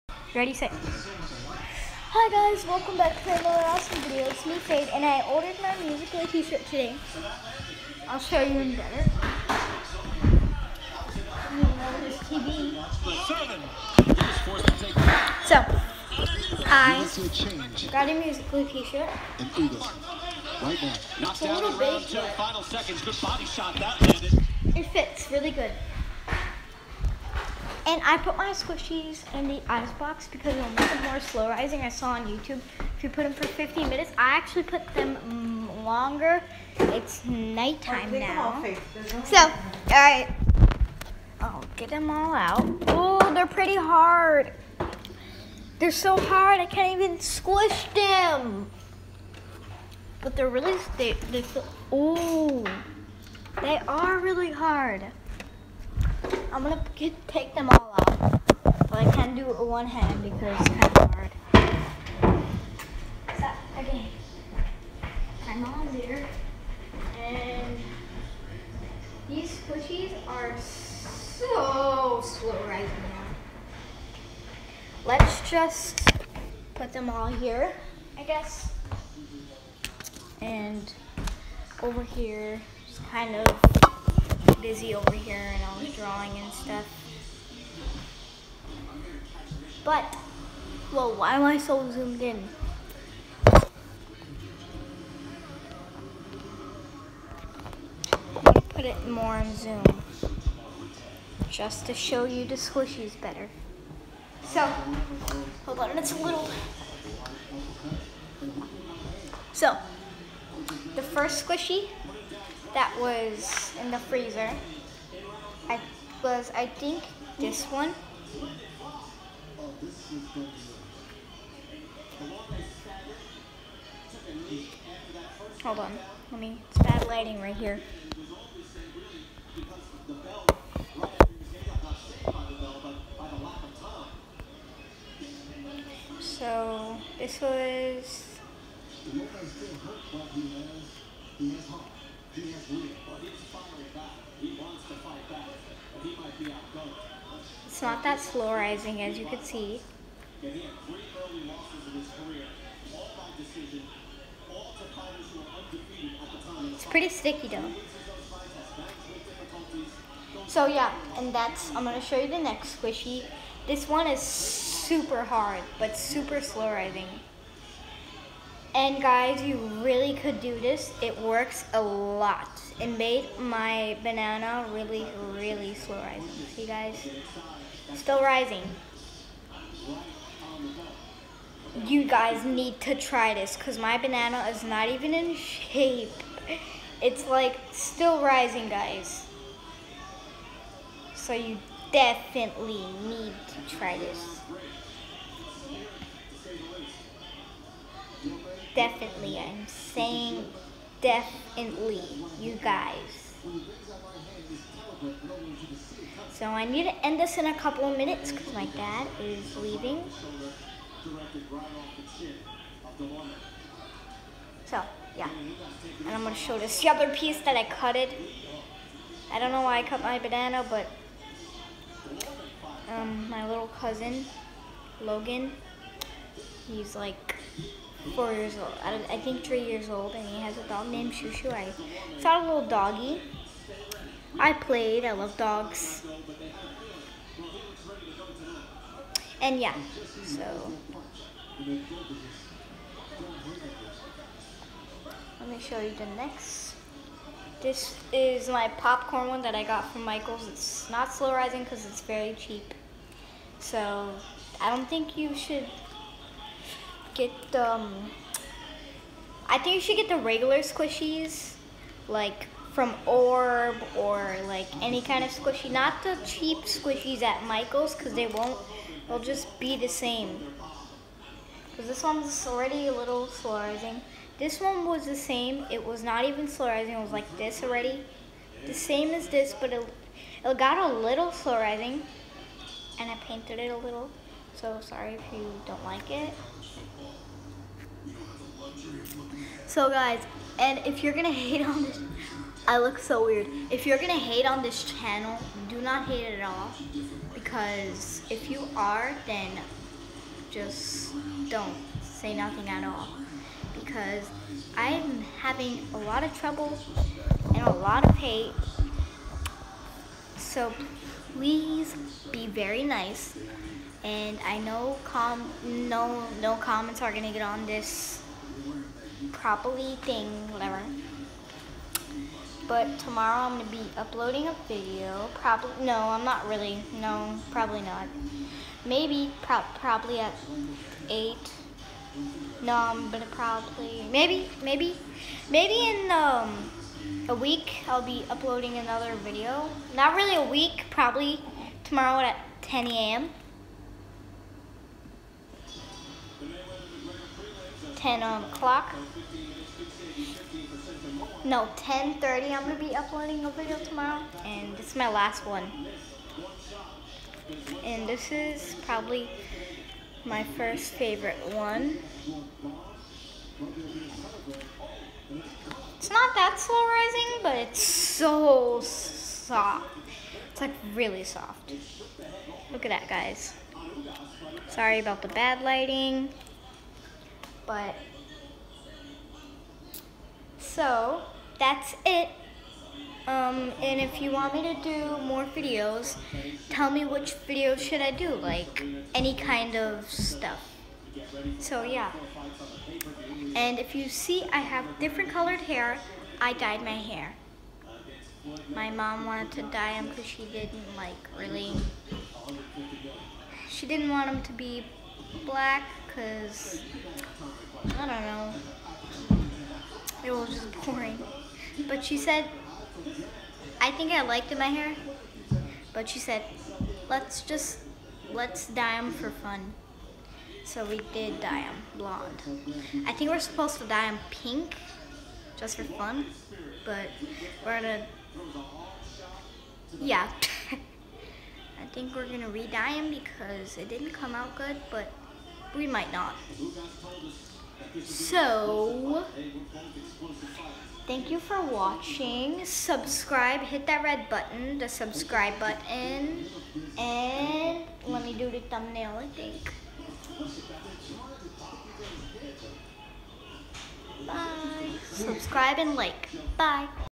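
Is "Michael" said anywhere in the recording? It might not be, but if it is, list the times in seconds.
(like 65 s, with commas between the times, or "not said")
250 s, 267 s.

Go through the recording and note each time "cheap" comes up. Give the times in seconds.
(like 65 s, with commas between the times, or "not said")
252 s, 266 s.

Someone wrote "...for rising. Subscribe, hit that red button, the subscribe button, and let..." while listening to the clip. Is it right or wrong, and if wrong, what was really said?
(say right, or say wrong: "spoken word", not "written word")
wrong: "watching", not "rising".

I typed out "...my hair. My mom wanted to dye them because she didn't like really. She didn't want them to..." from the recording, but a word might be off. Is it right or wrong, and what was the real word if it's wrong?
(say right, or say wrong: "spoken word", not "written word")
right.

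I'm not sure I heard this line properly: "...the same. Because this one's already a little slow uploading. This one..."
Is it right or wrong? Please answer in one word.
wrong.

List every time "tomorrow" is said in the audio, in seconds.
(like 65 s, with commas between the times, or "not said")
322 s, 341 s, 353 s.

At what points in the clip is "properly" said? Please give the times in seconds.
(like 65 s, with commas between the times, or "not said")
319 s.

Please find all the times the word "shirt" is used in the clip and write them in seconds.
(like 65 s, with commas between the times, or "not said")
6 s, 18 s.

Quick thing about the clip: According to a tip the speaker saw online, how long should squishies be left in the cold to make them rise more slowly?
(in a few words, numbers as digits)
15 minutes.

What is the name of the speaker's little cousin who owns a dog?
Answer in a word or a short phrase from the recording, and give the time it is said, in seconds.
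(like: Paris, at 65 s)
Logan, at 225 s.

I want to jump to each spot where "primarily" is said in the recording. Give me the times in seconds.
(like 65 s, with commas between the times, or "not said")
not said.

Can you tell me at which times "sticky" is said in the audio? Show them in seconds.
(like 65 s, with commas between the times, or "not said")
157 s.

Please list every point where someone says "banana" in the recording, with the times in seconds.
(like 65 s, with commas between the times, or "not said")
174 s, 183 s, 220 s.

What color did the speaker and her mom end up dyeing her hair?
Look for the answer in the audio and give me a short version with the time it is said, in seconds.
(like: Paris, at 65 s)
blonde, at 421 s.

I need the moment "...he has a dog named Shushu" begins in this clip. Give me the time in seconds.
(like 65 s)
230 s.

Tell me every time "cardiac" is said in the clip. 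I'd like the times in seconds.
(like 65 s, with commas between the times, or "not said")
not said.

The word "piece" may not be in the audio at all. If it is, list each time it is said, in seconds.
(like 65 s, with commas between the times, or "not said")
217 s.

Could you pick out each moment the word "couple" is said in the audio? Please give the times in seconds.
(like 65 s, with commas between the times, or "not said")
207 s.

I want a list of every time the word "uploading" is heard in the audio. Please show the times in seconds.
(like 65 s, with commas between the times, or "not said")
323 s, 338 s, 352 s.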